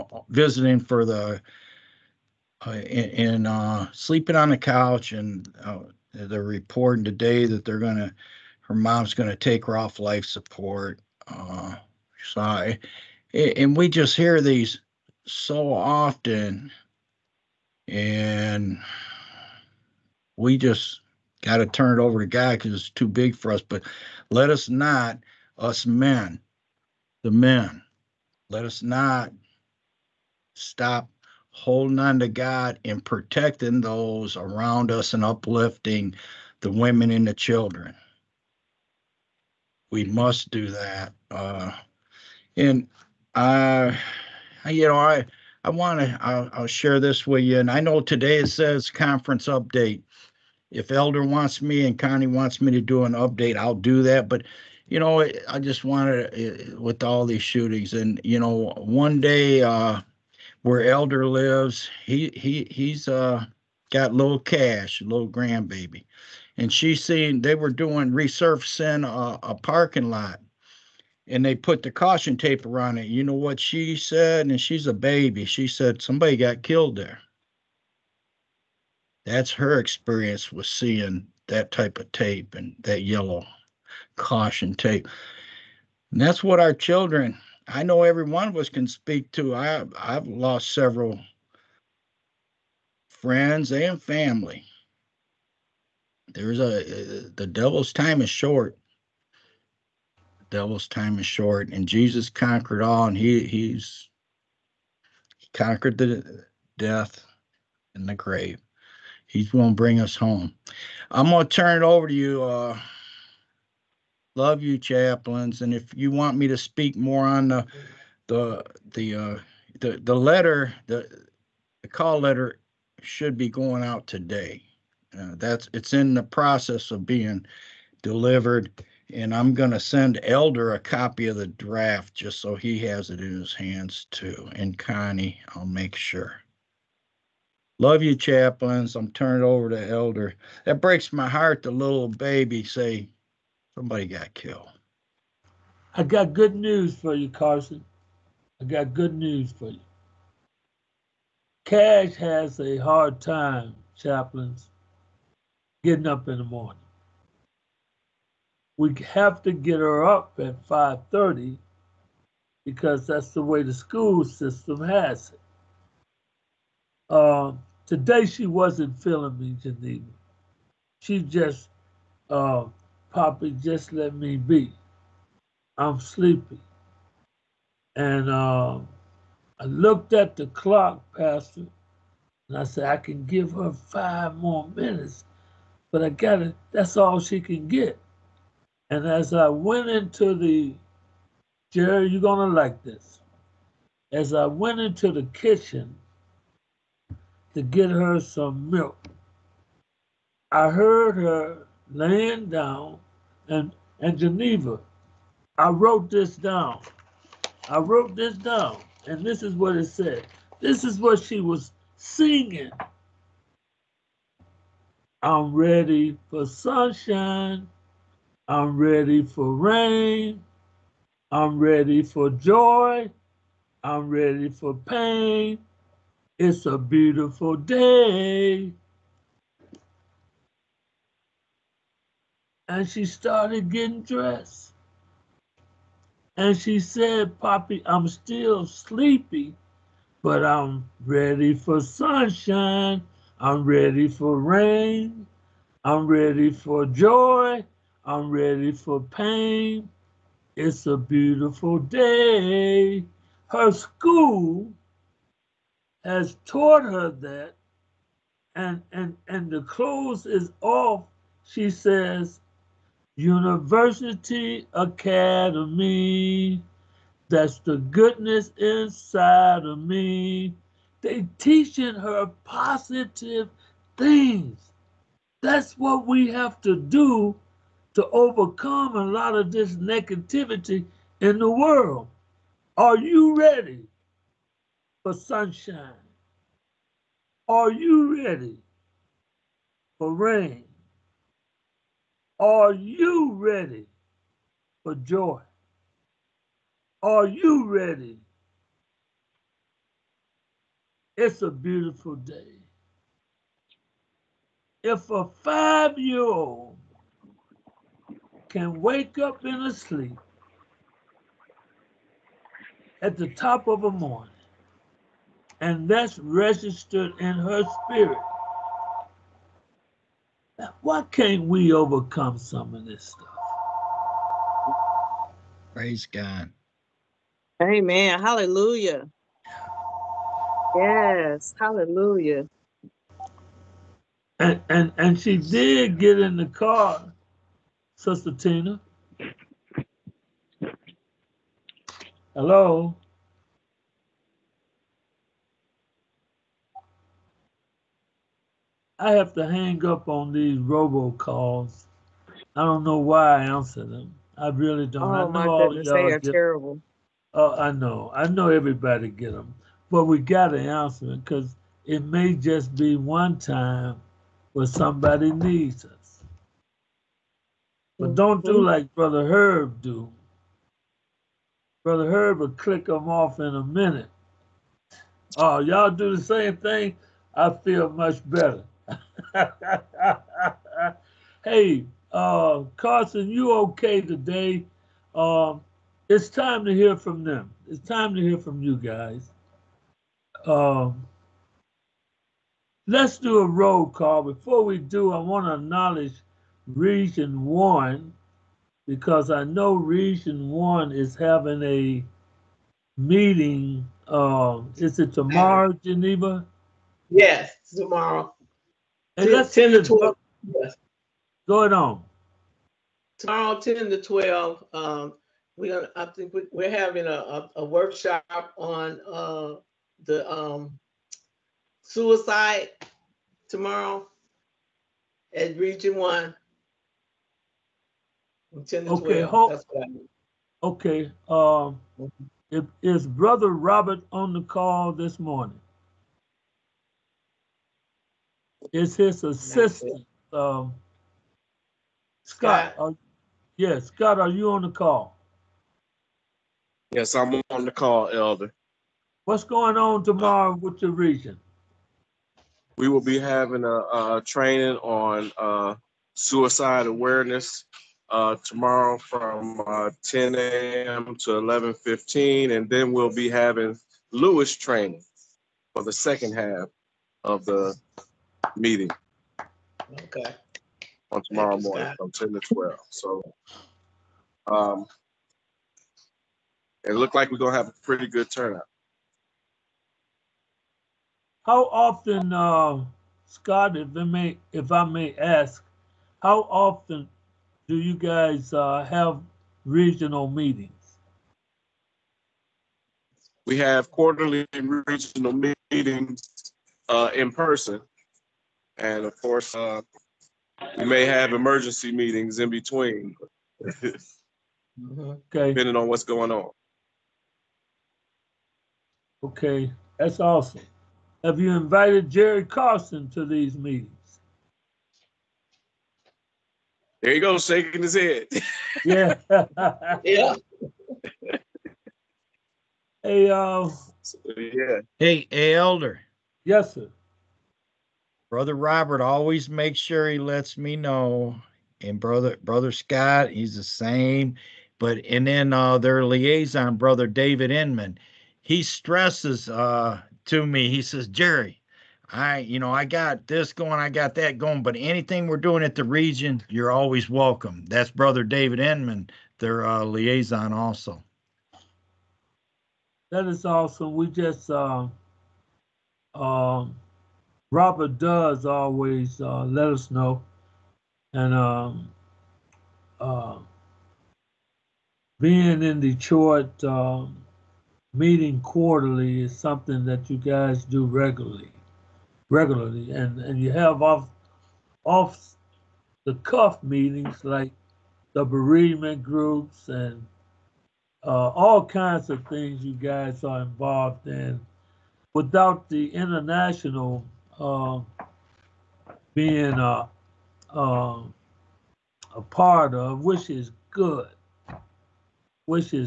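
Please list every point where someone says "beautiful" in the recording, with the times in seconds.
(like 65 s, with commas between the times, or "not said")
226 s, 250 s, 301 s.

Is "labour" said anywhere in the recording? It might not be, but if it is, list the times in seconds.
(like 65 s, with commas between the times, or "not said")
not said.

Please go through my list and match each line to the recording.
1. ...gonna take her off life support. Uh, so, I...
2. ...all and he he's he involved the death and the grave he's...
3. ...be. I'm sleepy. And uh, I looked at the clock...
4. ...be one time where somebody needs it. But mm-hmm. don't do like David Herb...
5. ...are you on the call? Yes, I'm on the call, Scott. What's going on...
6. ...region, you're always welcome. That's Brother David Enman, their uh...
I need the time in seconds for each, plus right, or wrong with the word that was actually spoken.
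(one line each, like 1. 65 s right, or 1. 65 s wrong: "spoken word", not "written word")
1. 9 s right
2. 102 s wrong: "conquered", not "involved"
3. 174 s right
4. 362 s wrong: "Brother", not "David"
5. 444 s wrong: "Elder", not "Scott"
6. 545 s right.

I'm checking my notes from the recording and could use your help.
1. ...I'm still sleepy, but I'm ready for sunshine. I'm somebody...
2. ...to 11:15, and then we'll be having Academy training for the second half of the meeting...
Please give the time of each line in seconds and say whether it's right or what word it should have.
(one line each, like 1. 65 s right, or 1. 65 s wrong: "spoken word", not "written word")
1. 237 s wrong: "ready", not "somebody"
2. 461 s wrong: "Lewis", not "Academy".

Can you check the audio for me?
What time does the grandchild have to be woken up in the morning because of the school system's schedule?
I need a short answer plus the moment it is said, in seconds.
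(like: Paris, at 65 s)
5:30, at 160 s.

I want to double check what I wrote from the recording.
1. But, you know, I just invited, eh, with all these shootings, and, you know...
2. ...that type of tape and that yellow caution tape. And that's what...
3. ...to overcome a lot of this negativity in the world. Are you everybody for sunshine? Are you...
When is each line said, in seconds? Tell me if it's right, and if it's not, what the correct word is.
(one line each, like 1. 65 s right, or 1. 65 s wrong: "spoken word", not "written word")
1. 54 s wrong: "wanted", not "invited"
2. 81 s right
3. 277 s wrong: "ready", not "everybody".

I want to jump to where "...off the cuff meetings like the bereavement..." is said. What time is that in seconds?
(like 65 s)
574 s.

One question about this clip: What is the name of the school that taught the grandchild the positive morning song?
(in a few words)
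University Academy.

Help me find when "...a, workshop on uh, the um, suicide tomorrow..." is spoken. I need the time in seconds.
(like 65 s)
417 s.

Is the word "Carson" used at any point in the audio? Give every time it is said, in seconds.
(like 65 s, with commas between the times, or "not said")
147 s, 382 s, 512 s.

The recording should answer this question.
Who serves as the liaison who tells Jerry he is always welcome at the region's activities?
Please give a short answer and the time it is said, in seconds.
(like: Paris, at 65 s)
David Inman, at 537 s.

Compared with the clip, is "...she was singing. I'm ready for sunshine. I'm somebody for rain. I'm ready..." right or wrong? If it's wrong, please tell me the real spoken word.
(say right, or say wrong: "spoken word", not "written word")
wrong: "ready", not "somebody".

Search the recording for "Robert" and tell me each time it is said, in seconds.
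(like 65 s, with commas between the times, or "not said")
433 s, 528 s, 557 s.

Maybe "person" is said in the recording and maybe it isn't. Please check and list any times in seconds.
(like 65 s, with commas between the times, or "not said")
497 s.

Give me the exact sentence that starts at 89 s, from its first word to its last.
I, I've lost several friends and family.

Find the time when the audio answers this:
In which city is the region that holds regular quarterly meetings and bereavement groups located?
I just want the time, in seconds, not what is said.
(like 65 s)
565 s.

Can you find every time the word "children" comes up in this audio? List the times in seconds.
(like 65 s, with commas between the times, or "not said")
37 s, 86 s.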